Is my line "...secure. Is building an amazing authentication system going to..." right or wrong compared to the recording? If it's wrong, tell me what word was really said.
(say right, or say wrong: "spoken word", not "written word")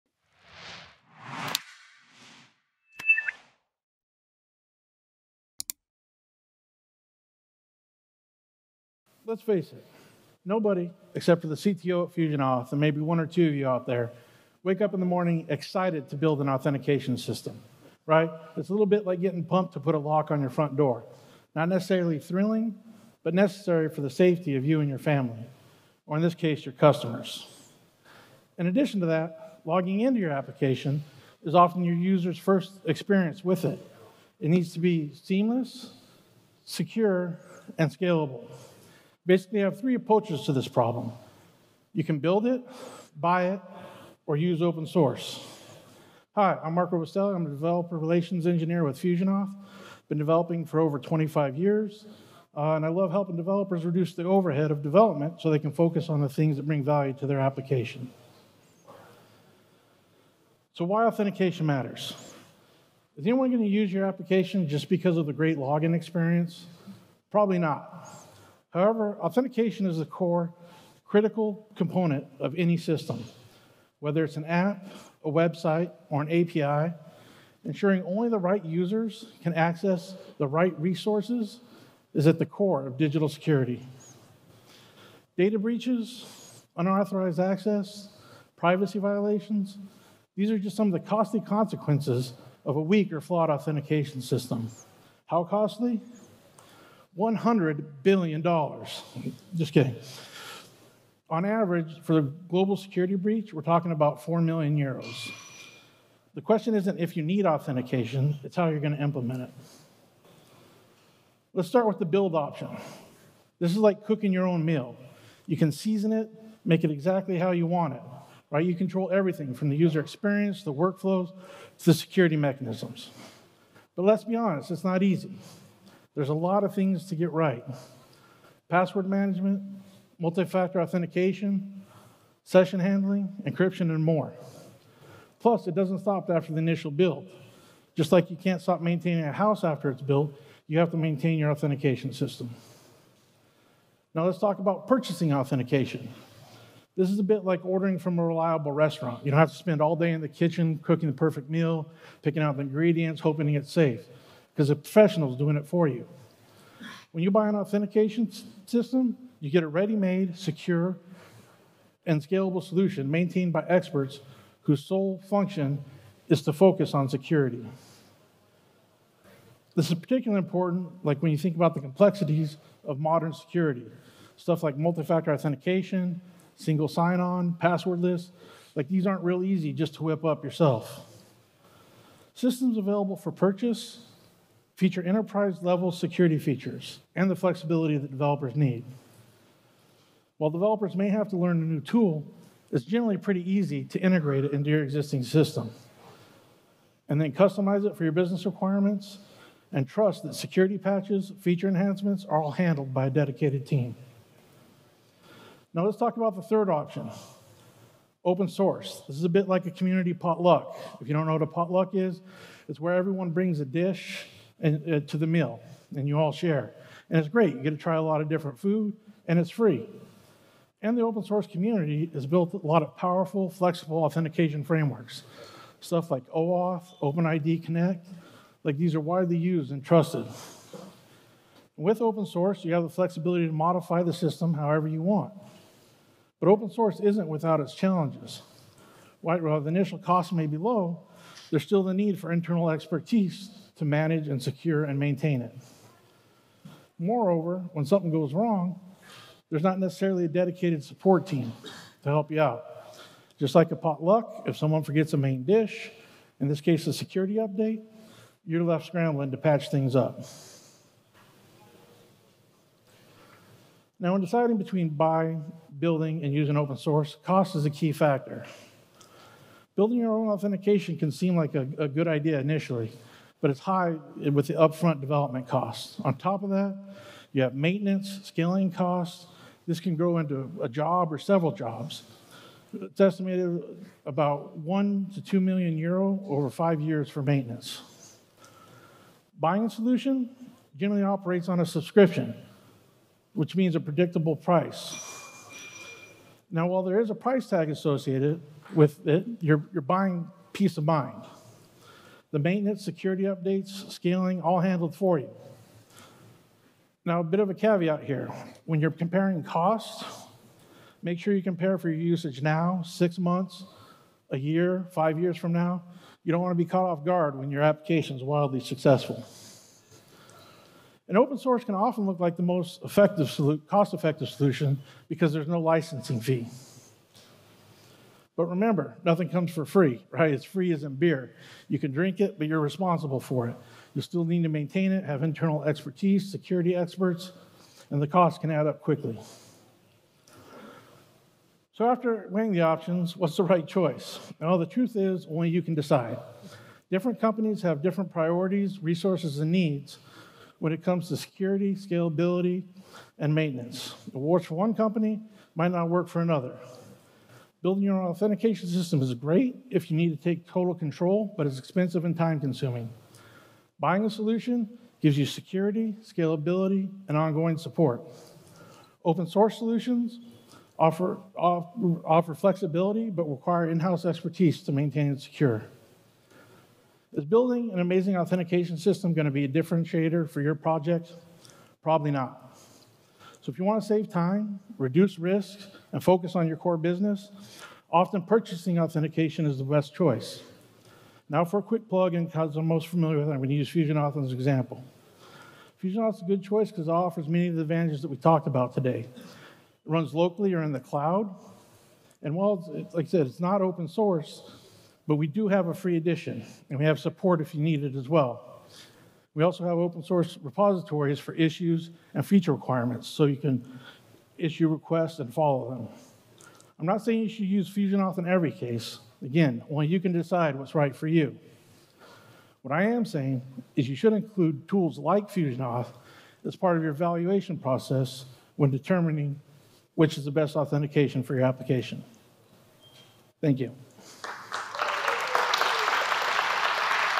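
right.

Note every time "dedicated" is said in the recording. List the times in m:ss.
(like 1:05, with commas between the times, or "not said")
3:23, 4:10.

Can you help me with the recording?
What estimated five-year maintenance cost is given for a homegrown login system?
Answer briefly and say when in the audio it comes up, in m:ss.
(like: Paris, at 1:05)
1 to 2 million euro, at 4:44.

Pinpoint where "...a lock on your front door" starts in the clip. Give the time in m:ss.
0:19.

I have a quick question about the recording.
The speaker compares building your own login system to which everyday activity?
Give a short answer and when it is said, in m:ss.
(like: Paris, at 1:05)
cooking your own meal, at 1:54.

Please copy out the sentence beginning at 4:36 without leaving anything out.
On top of that, you have maintenance, scaling costs.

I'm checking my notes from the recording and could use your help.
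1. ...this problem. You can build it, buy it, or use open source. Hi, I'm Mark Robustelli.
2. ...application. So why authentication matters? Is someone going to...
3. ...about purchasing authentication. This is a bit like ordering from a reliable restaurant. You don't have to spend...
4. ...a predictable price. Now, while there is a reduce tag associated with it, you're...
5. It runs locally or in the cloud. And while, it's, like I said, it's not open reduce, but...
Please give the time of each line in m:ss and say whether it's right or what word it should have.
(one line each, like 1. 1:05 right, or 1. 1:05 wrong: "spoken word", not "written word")
1. 0:40 right
2. 0:57 wrong: "anyone", not "someone"
3. 2:24 right
4. 4:53 wrong: "price", not "reduce"
5. 6:39 wrong: "source", not "reduce".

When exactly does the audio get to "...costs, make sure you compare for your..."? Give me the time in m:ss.
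5:09.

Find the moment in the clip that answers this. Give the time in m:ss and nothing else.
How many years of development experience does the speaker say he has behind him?
0:50.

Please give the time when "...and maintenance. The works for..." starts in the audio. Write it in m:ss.
5:53.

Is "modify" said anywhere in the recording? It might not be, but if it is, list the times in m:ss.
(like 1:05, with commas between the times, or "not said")
3:53.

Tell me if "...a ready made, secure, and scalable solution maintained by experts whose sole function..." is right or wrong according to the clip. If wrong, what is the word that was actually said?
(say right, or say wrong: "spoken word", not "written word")
right.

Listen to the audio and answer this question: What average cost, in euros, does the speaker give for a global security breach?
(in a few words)
4 million euros.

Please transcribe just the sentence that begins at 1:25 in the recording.
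Data breaches, unauthorized access, privacy violations, these are just some of the costly consequences of a weak or flawed authentication system.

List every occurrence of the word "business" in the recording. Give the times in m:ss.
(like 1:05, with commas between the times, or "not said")
3:18, 6:26.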